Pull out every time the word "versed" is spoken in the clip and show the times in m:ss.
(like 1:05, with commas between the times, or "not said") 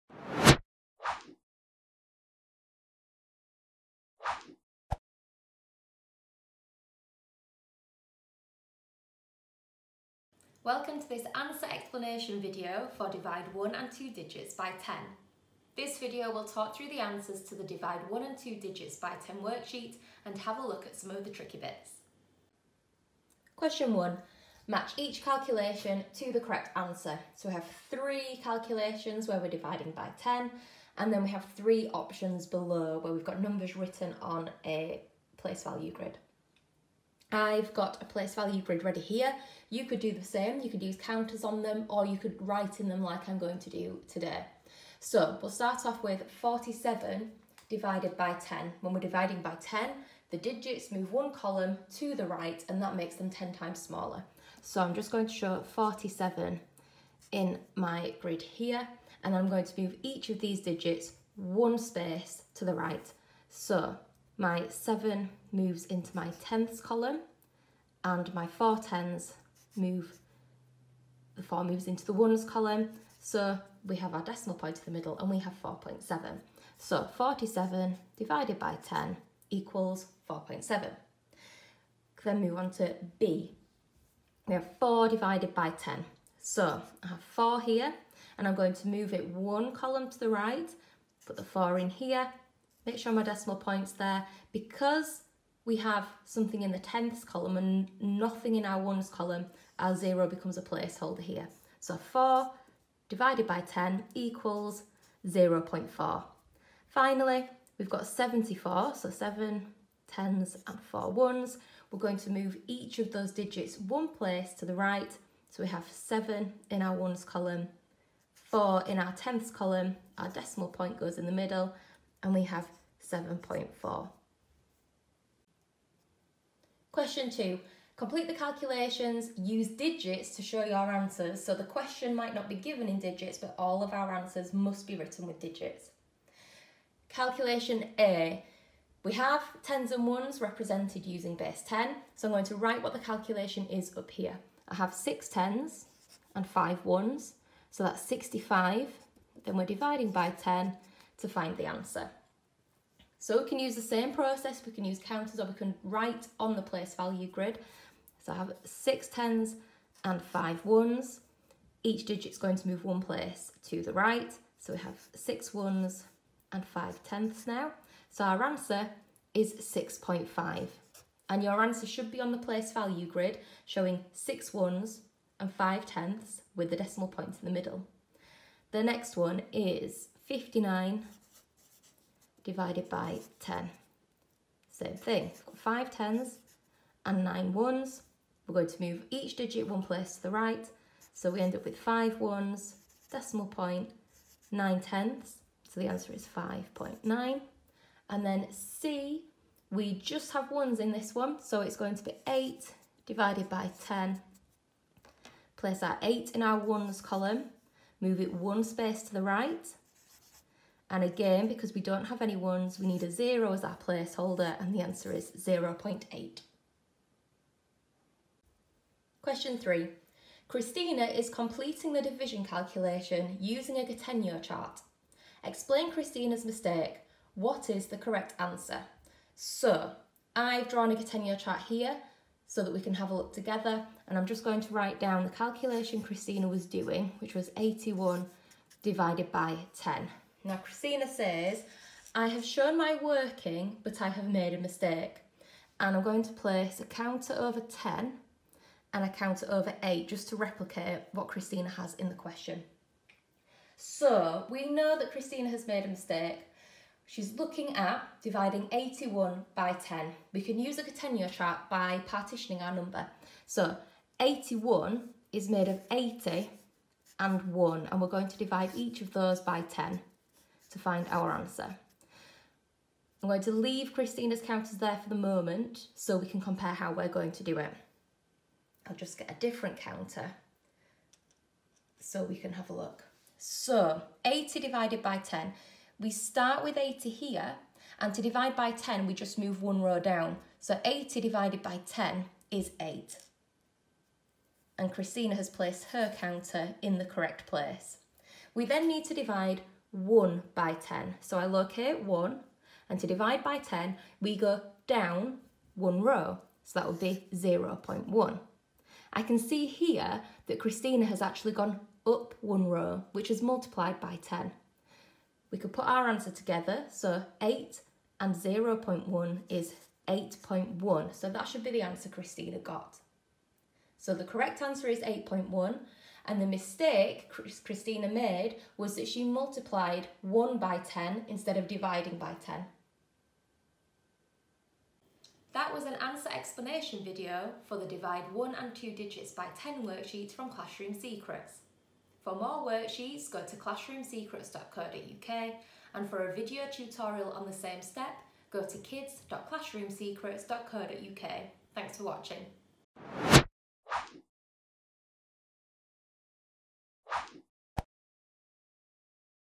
not said.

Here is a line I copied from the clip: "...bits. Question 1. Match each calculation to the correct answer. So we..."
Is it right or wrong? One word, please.
right.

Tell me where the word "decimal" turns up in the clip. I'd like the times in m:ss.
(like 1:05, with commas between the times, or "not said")
1:14, 1:33, 2:00, 2:56, 3:13.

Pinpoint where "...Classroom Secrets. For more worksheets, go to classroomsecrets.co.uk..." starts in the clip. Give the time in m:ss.
5:40.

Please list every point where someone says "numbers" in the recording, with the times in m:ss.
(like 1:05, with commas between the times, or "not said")
0:33, 4:22.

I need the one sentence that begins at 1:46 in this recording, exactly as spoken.
Finally, we've got 74, so 7 tens and 4 ones.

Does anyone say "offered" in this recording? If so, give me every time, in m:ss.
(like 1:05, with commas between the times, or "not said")
not said.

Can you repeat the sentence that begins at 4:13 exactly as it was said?
So we know that Christina has made a mistake.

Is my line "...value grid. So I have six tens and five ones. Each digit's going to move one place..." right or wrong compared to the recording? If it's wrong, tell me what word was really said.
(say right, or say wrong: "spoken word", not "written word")
right.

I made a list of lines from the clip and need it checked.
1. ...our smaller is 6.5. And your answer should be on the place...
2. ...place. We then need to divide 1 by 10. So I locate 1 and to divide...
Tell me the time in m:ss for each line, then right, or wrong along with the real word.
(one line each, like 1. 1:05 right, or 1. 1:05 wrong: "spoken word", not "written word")
1. 2:48 wrong: "answer", not "smaller"
2. 4:57 right.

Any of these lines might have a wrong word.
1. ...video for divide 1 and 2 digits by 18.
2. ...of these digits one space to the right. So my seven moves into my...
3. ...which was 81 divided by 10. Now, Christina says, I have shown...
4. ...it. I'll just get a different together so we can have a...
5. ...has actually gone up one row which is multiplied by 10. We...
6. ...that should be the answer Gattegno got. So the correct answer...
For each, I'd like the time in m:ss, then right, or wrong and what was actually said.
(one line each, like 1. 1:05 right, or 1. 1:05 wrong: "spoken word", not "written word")
1. 0:12 wrong: "10", not "18"
2. 1:00 right
3. 3:57 right
4. 4:37 wrong: "counter", not "together"
5. 5:11 right
6. 5:21 wrong: "Christina", not "Gattegno".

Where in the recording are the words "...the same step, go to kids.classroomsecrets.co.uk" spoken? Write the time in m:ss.
5:47.